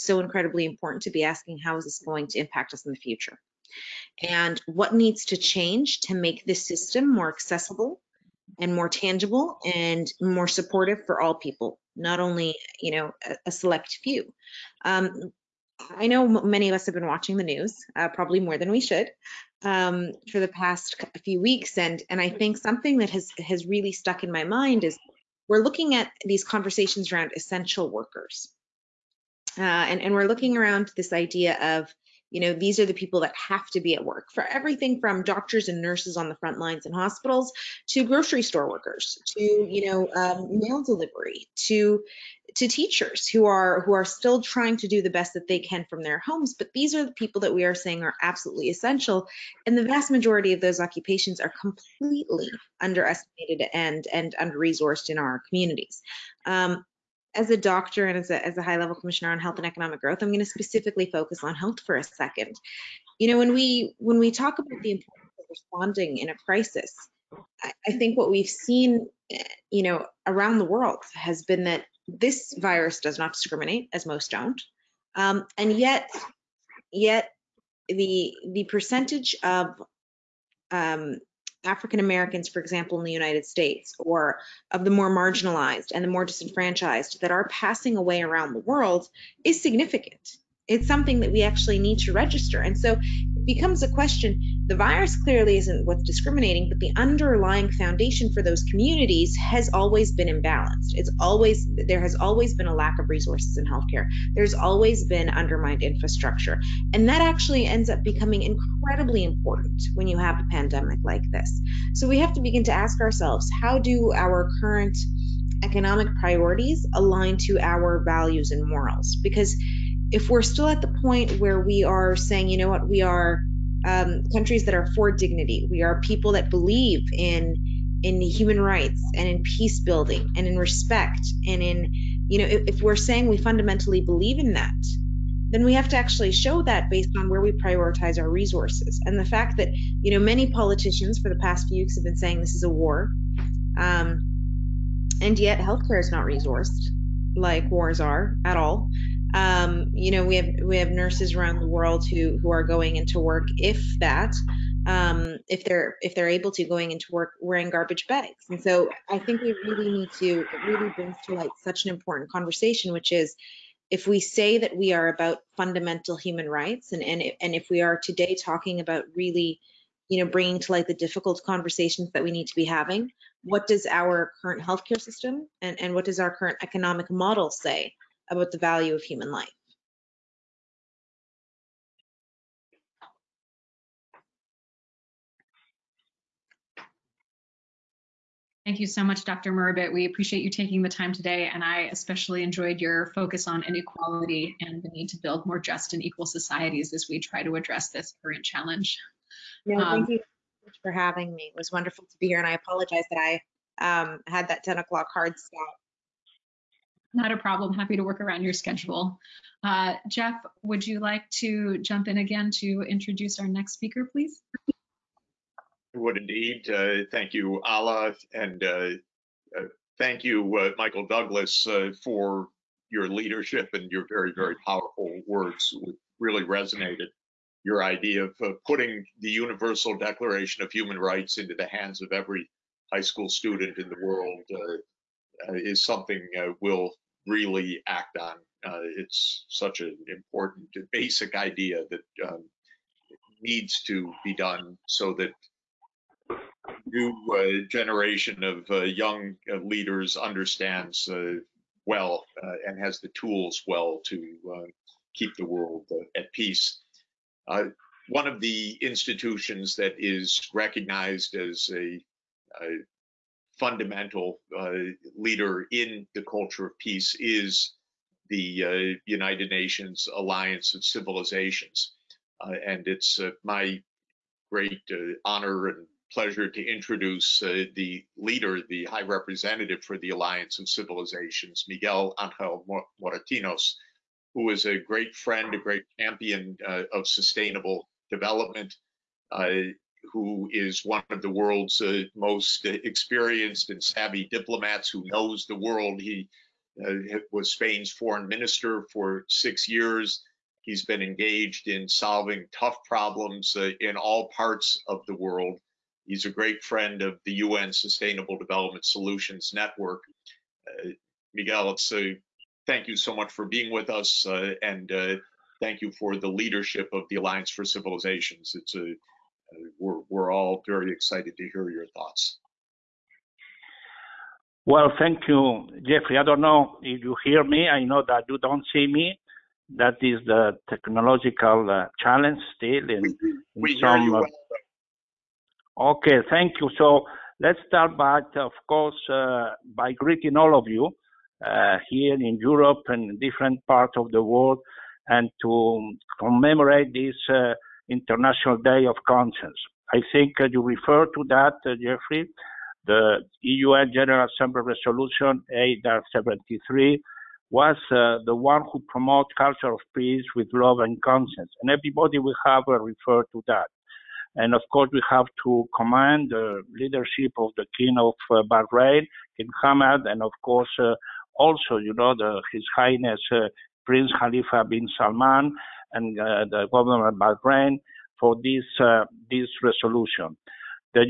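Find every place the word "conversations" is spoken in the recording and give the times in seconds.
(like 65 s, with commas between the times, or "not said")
26 s, 162 s, 171 s.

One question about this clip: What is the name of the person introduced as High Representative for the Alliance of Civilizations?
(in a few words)
Miguel Angel Moratinos.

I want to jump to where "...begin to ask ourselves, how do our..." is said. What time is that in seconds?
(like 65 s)
112 s.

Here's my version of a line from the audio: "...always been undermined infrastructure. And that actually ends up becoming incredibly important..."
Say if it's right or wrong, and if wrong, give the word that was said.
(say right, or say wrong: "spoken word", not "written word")
right.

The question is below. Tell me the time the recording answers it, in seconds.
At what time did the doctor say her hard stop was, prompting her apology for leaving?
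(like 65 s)
204 s.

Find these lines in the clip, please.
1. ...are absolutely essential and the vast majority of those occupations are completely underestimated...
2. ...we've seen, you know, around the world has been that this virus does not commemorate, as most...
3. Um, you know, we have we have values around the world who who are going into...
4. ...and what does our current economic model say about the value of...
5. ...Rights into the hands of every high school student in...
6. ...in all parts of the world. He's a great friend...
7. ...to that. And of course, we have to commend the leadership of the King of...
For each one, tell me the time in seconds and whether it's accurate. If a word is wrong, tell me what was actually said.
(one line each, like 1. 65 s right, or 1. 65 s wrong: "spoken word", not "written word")
1. 48 s right
2. 68 s wrong: "discriminate", not "commemorate"
3. 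149 s wrong: "nurses", not "values"
4. 175 s right
5. 230 s right
6. 303 s right
7. 363 s right.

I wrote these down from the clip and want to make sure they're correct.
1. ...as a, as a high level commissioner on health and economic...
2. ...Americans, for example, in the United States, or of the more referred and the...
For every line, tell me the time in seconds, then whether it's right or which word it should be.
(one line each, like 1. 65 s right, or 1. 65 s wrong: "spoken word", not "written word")
1. 58 s right
2. 81 s wrong: "marginalized", not "referred".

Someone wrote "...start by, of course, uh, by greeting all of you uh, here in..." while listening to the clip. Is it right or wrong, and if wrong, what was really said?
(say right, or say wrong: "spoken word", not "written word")
right.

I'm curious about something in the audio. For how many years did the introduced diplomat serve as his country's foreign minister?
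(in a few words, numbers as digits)
6.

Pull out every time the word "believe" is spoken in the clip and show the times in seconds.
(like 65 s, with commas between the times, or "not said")
126 s, 133 s.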